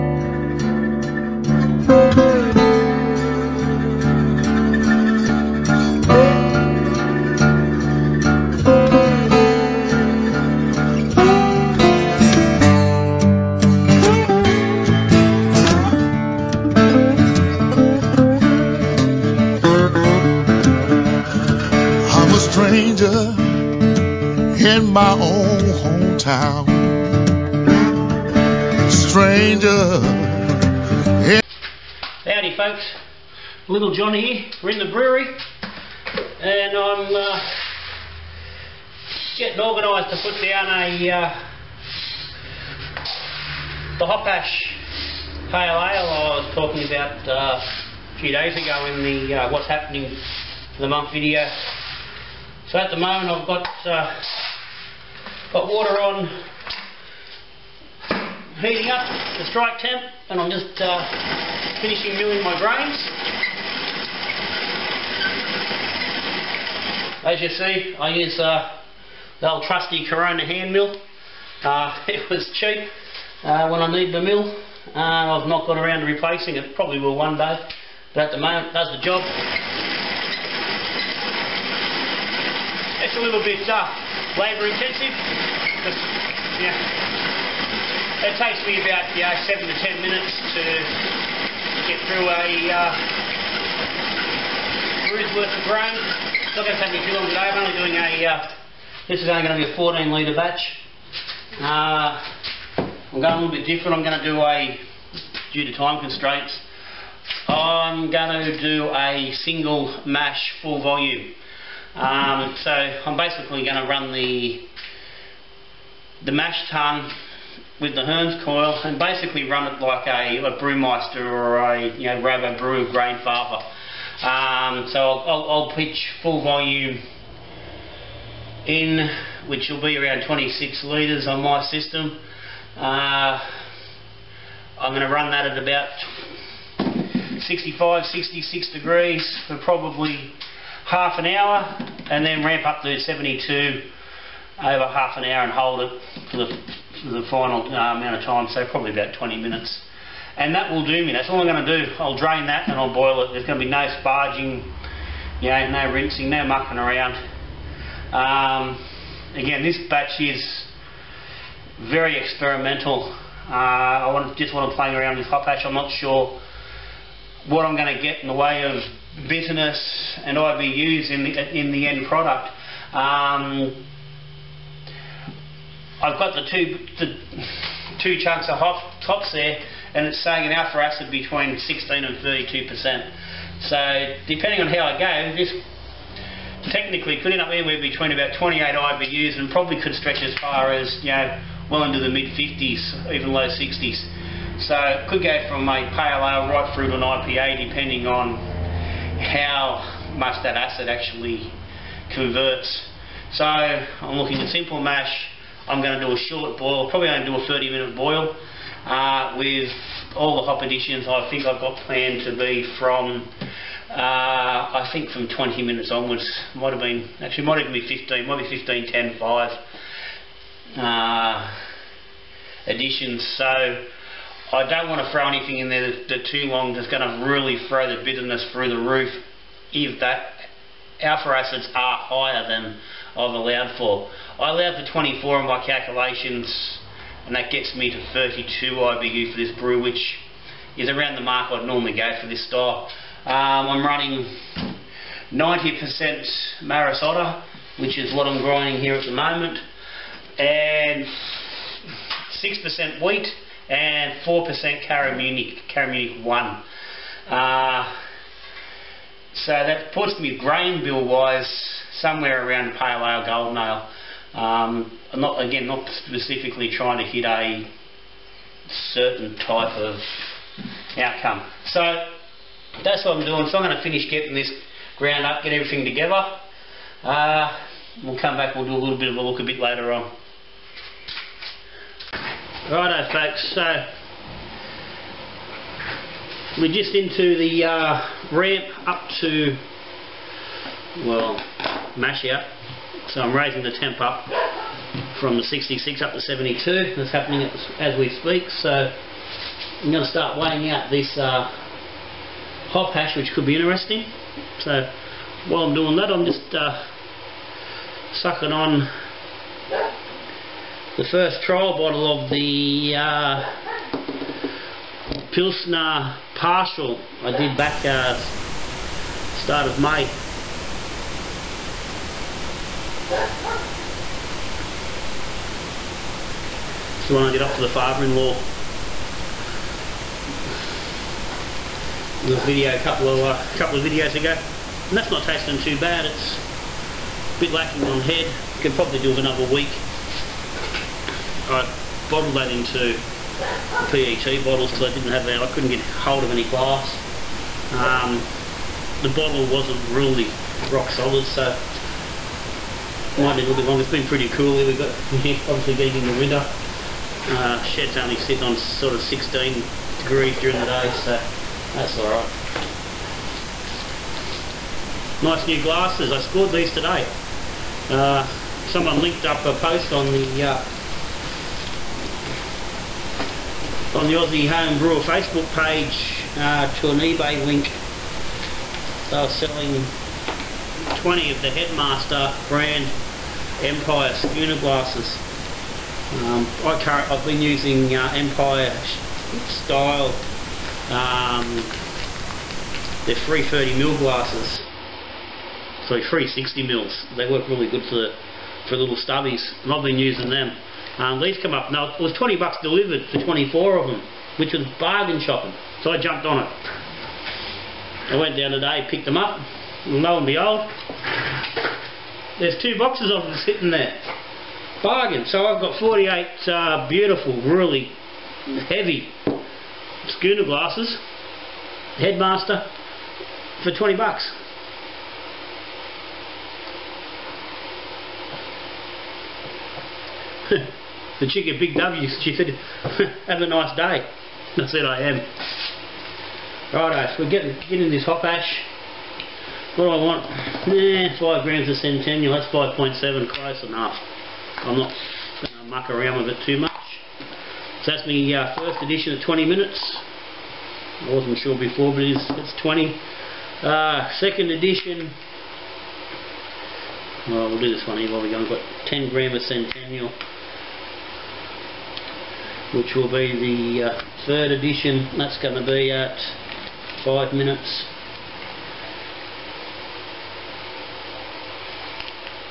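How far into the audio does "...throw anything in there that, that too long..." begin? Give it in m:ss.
3:45.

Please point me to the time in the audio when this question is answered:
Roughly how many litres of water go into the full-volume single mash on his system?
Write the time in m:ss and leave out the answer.
2:10.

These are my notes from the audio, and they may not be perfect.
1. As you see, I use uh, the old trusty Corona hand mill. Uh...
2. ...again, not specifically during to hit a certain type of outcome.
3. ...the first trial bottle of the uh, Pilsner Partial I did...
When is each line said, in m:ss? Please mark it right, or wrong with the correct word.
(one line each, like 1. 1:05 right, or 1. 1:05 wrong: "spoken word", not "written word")
1. 1:07 right
2. 4:25 wrong: "trying", not "during"
3. 5:10 right.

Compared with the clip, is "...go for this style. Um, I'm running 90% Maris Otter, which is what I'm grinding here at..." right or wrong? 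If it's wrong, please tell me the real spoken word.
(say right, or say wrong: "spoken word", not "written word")
right.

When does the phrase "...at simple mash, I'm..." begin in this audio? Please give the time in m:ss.
3:24.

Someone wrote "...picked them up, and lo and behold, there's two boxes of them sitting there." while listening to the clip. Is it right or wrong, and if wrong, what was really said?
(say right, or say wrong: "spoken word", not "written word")
right.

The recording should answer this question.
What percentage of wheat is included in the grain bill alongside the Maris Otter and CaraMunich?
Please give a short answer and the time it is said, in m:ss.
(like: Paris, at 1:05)
6%, at 4:12.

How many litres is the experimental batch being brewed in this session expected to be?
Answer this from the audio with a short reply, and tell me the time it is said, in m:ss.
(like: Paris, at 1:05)
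14 litres, at 1:39.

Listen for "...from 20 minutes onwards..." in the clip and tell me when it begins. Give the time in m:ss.
3:35.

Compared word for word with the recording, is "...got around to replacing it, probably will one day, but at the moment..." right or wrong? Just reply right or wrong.
right.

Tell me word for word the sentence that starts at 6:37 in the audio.
they work really good for the, for little stubbies, and I've been using them.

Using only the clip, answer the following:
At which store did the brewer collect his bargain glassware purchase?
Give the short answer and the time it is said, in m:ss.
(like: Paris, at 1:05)
Big W, at 7:11.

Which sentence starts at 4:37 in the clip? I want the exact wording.
Uh, we'll come back, we'll do a little bit of a look a bit later on.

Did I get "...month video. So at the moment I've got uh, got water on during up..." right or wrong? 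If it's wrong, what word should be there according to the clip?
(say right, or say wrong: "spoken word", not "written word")
wrong: "heating", not "during".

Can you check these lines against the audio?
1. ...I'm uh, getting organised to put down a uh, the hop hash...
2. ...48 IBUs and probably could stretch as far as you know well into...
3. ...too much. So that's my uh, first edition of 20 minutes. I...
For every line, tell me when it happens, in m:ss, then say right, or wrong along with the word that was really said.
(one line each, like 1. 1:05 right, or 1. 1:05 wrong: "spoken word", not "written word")
1. 0:36 right
2. 3:08 wrong: "28", not "48"
3. 7:26 right.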